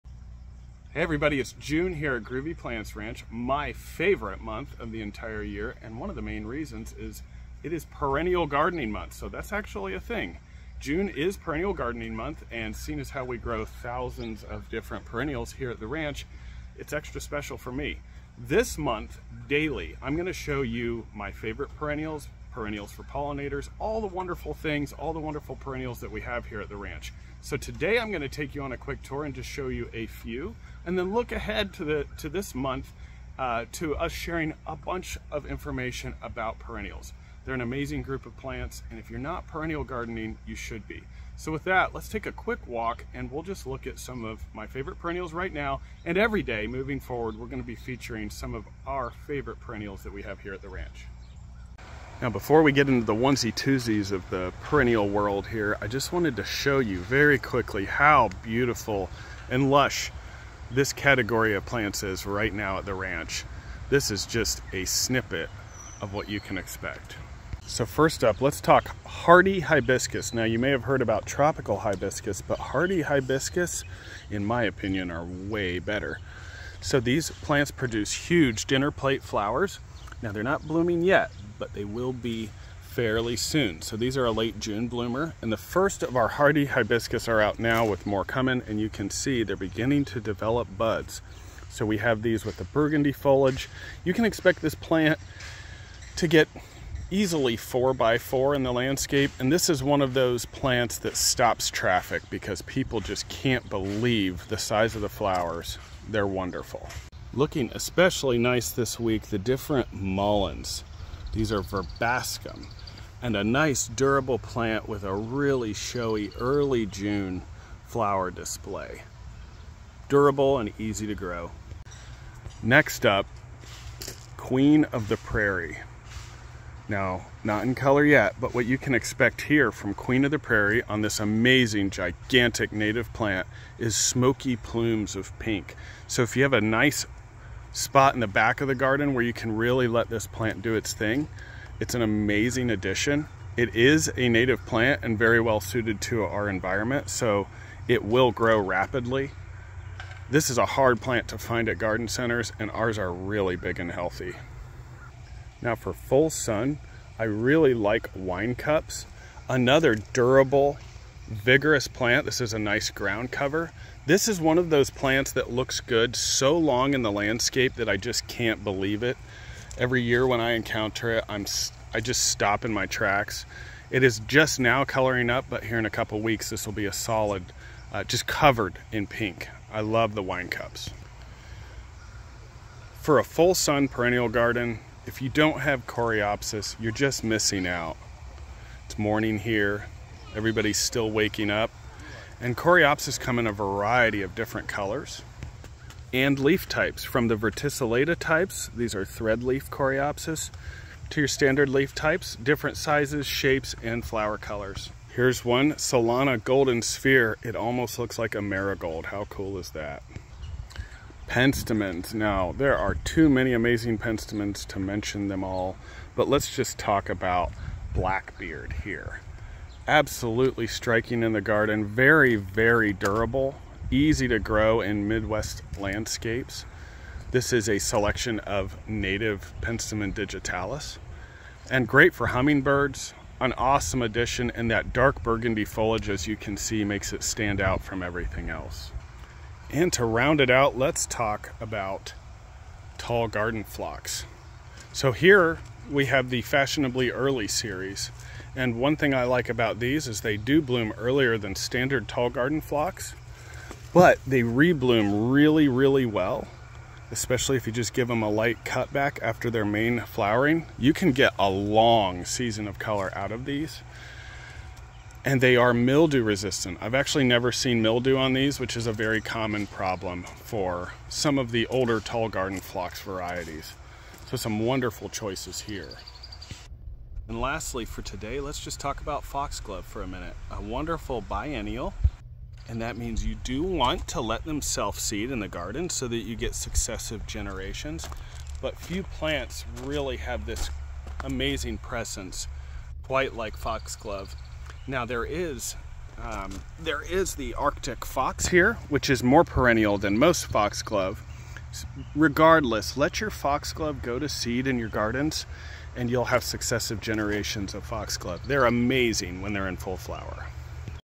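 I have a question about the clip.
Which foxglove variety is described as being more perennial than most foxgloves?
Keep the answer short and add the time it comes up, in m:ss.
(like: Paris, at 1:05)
Arctic Fox, at 4:57.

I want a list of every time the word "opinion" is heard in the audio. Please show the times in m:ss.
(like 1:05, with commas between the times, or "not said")
1:14.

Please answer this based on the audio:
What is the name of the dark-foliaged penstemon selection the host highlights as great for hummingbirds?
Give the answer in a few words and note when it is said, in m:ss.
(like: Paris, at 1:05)
Blackbeard, at 3:37.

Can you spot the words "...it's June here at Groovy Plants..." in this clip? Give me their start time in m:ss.
0:01.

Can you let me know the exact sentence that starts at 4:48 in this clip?
But few plants really have this amazing presence, quite like foxglove.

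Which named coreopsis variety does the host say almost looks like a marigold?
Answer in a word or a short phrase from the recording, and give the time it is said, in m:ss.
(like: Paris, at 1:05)
Solanna Golden Sphere, at 3:25.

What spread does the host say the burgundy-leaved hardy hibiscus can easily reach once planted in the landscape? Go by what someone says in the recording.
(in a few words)
4 by 4.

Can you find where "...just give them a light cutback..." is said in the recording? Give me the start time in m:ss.
4:17.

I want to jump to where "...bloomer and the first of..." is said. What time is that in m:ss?
1:24.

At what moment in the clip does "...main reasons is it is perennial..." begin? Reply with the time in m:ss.
0:06.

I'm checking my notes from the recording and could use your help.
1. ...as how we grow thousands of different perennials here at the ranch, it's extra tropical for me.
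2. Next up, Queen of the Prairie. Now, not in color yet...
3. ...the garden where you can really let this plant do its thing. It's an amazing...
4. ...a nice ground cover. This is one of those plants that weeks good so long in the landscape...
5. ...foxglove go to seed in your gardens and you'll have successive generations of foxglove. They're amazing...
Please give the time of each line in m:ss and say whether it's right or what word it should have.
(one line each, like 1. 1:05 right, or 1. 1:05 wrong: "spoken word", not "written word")
1. 0:12 wrong: "special", not "tropical"
2. 2:02 right
3. 2:18 right
4. 2:42 wrong: "looks", not "weeks"
5. 5:03 right.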